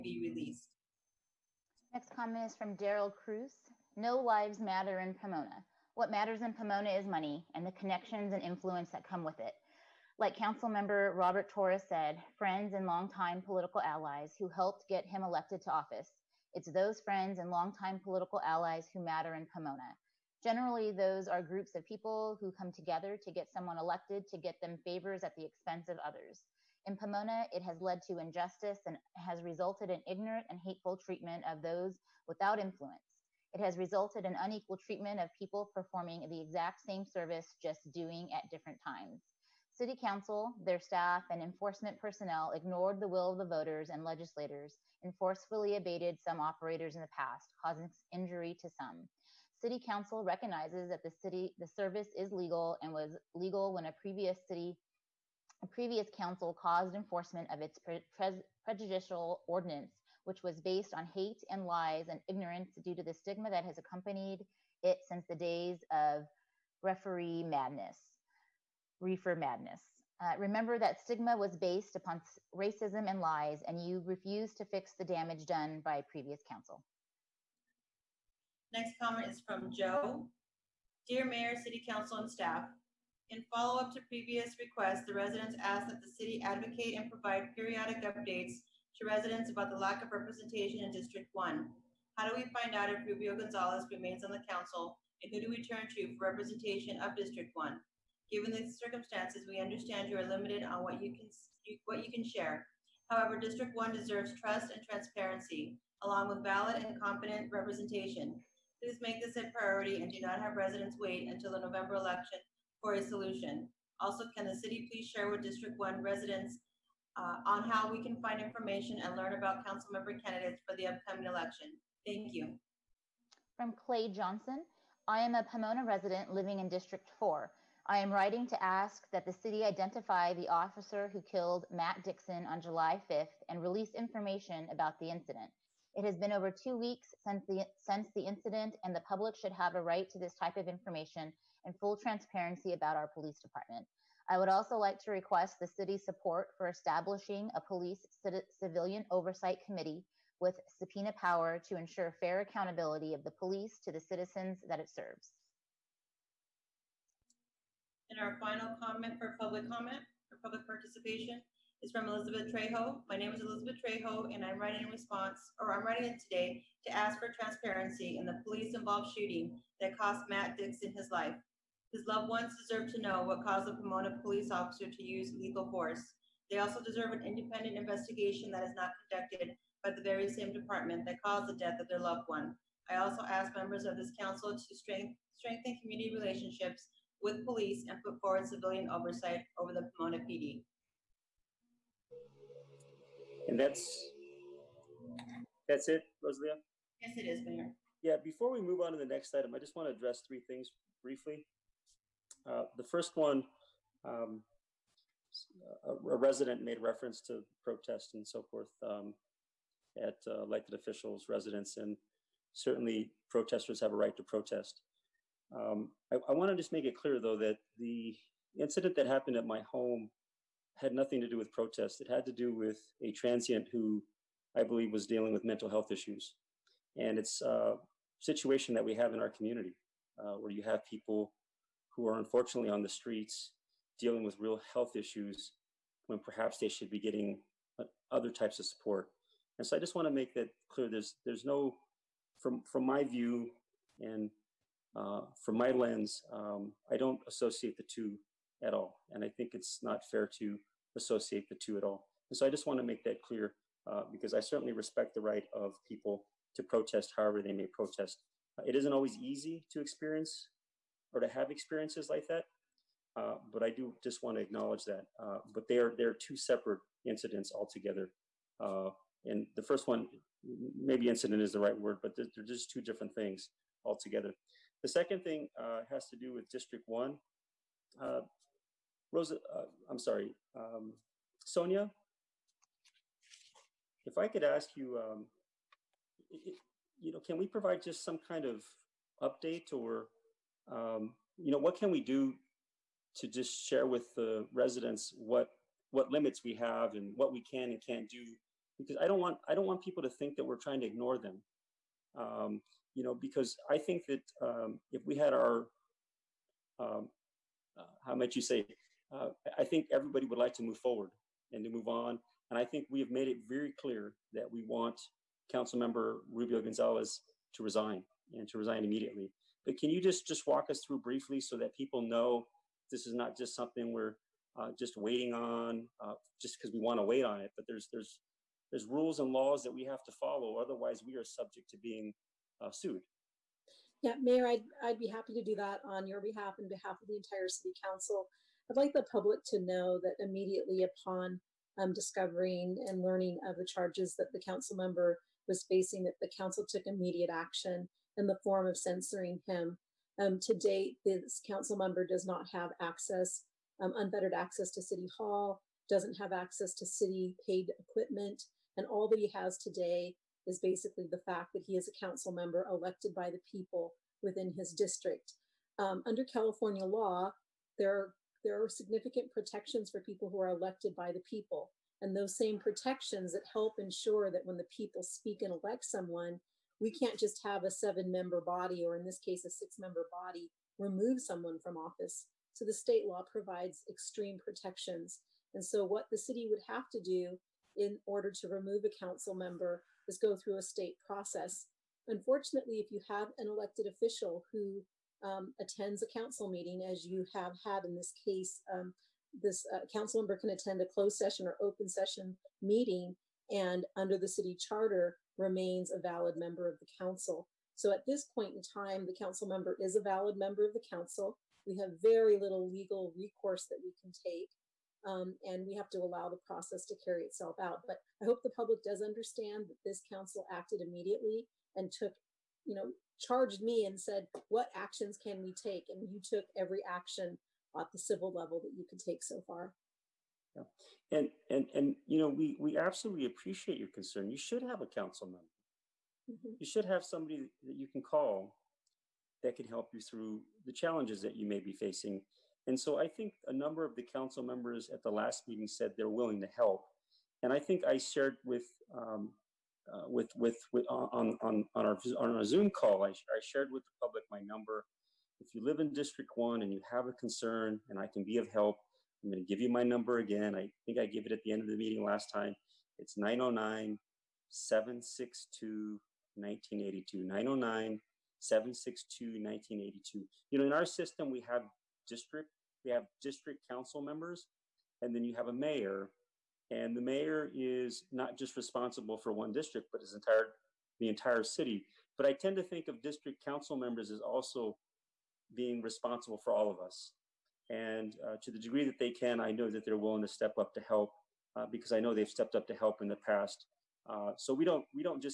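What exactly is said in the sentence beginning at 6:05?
Um, under California law, there are there are significant protections for people who are elected by the people.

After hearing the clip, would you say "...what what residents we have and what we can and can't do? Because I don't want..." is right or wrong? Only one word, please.
wrong.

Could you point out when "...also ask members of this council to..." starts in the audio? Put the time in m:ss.
3:02.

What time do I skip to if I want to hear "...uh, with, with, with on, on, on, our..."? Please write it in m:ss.
7:29.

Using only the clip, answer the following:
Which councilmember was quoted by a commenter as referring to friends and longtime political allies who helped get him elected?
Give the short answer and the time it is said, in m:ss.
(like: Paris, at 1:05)
Robert Torres, at 0:11.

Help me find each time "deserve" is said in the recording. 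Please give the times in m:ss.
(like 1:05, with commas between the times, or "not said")
1:43, 2:52, 2:56.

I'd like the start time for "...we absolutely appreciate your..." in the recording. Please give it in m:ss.
7:12.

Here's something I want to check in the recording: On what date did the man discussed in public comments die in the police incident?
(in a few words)
July 5th.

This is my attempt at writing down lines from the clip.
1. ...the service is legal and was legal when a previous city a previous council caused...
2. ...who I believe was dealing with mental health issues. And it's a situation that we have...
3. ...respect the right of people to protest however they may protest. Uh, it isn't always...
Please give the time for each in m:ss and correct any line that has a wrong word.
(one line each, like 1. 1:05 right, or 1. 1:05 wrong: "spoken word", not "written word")
1. 0:51 right
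2. 3:43 right
3. 4:14 right.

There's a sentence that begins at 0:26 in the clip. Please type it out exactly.
In Pomona, it has led to injustice and has resulted in ignorant and hateful treatment of those without influence.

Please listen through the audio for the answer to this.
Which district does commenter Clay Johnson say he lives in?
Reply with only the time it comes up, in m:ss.
2:06.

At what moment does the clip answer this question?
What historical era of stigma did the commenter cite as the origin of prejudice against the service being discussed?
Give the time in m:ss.
1:08.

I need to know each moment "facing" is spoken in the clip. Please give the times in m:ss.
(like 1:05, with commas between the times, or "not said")
5:45, 7:21.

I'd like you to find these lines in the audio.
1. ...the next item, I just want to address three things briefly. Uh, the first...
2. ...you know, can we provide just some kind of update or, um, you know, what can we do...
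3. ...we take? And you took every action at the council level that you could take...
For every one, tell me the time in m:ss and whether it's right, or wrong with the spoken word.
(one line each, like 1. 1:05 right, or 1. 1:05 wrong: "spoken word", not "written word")
1. 3:18 right
2. 4:46 right
3. 7:05 wrong: "civil", not "council".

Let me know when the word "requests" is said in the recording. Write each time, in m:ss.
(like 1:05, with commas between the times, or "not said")
1:24, 2:25.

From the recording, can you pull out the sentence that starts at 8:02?
But I tend to think of district council members as also being responsible for all of us.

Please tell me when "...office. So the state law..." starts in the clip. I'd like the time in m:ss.
6:21.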